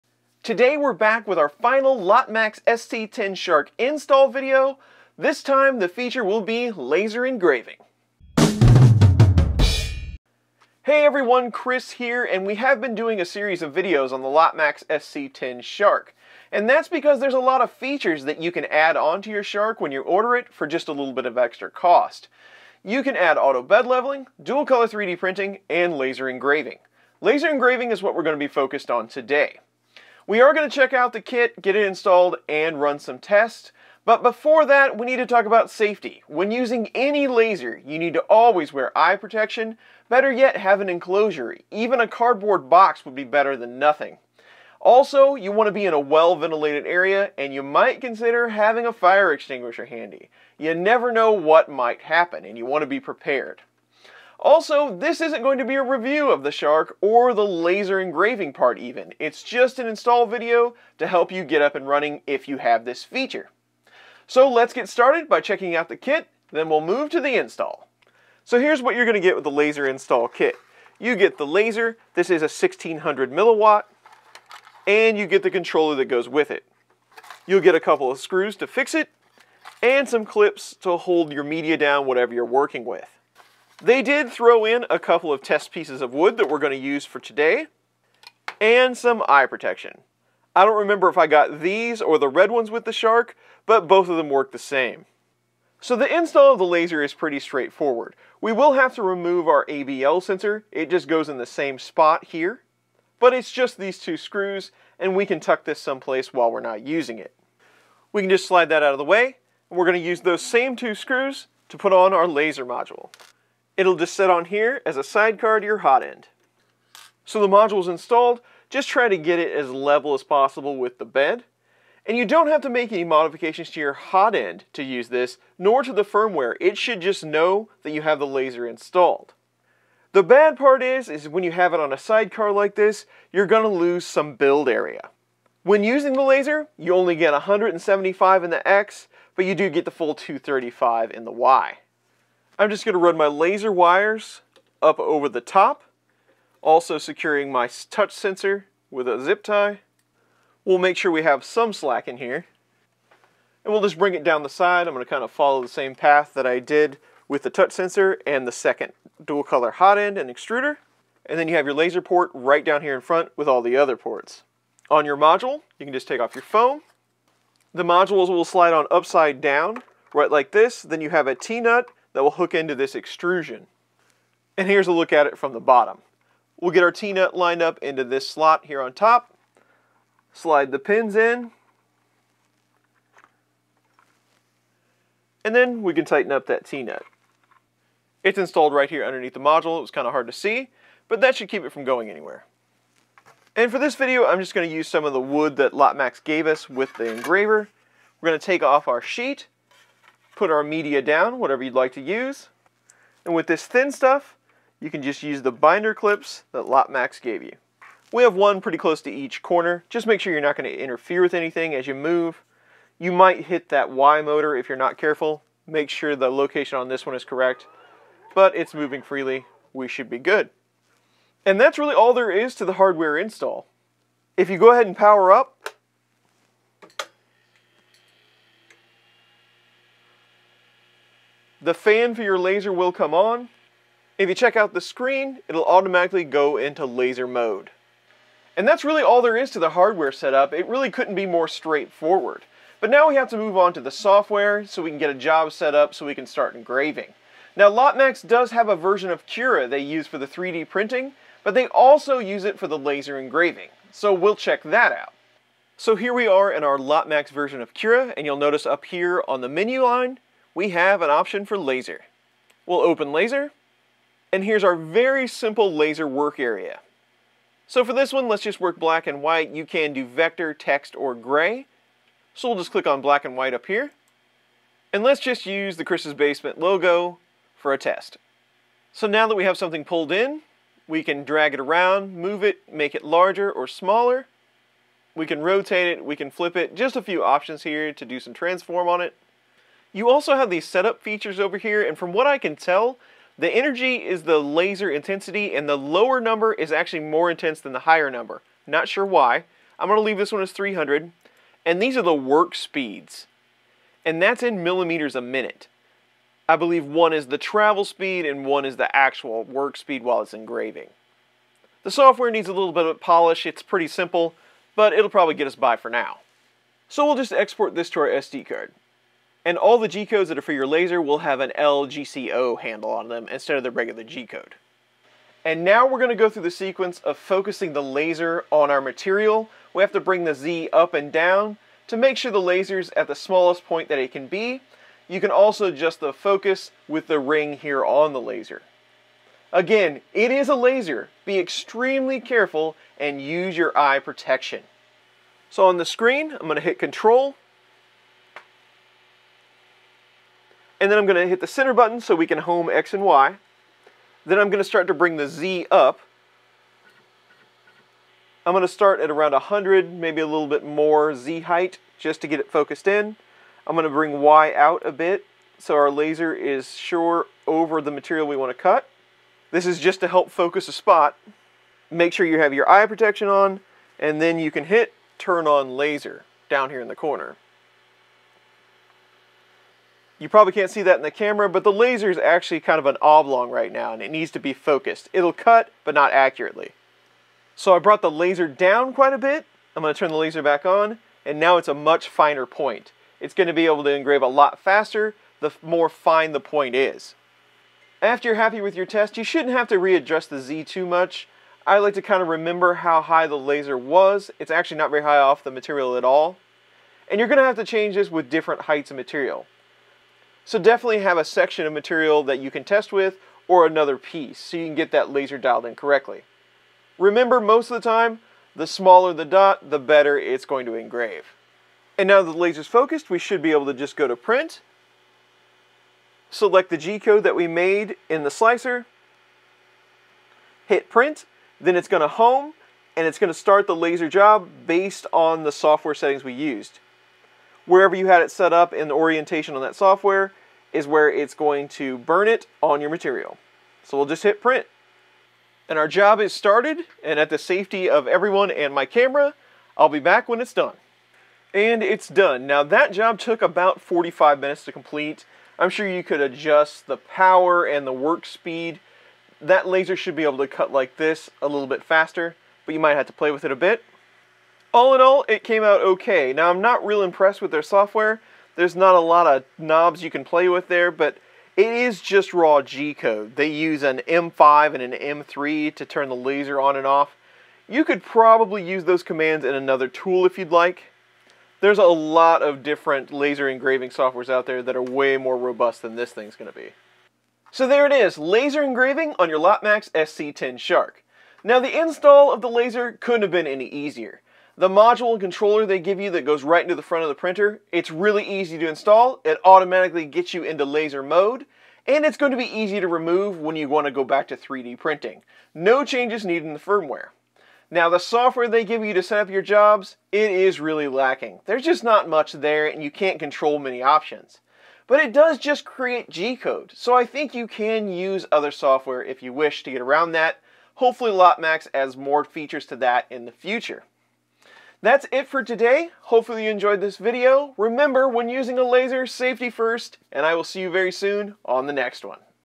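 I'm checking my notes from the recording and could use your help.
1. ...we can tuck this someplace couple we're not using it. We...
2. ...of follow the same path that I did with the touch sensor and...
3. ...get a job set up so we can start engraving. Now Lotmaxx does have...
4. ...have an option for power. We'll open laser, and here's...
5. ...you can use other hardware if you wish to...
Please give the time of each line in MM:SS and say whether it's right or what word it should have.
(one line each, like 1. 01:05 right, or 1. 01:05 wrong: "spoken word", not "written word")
1. 01:45 wrong: "while", not "couple"
2. 02:35 right
3. 04:04 right
4. 04:20 wrong: "laser", not "power"
5. 08:37 wrong: "software", not "hardware".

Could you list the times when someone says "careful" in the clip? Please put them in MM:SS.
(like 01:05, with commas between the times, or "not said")
03:34, 05:42.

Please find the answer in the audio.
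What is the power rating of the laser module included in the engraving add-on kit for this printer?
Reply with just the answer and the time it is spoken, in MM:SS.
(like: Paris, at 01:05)
1600 milliwatt, at 01:12.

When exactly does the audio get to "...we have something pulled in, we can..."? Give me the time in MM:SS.
04:39.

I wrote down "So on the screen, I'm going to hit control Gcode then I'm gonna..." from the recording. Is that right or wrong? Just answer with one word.
wrong.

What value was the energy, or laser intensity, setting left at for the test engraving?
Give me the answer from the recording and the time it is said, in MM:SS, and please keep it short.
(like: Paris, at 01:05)
300, at 05:00.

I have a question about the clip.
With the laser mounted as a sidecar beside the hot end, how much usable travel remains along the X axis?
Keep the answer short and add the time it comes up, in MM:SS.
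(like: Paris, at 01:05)
175, at 02:17.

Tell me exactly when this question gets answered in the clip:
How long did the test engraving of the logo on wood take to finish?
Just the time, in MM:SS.
07:33.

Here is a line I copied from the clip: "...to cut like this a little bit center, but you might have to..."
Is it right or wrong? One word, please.
wrong.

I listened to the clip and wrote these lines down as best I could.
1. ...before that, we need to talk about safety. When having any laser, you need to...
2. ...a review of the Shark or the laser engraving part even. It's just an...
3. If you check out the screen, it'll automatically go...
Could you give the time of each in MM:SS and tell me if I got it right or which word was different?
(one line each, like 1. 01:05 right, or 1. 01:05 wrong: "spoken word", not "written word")
1. 00:34 wrong: "using", not "having"
2. 00:55 right
3. 03:54 right.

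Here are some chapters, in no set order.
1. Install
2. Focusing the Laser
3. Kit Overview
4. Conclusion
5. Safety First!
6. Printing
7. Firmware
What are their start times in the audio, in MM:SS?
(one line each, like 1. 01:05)
1. 01:35
2. 05:25
3. 01:04
4. 08:07
5. 00:34
6. 07:02
7. 04:03.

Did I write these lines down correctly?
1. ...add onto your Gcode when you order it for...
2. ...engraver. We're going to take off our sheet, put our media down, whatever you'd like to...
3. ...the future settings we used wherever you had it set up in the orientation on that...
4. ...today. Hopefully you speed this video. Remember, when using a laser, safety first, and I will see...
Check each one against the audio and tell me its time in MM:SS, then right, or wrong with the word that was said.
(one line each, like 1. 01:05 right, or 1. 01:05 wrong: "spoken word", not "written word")
1. 00:18 wrong: "Shark", not "Gcode"
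2. 03:17 right
3. 07:15 wrong: "software", not "future"
4. 08:45 wrong: "enjoyed", not "speed".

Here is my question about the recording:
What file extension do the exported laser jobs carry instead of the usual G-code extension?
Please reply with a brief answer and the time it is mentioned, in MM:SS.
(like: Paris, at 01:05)
LGCO, at 05:21.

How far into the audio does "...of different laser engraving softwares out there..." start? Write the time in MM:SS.
08:02.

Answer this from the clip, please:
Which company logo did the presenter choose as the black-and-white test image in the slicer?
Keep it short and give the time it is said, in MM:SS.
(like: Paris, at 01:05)
Chris's Basement, at 04:35.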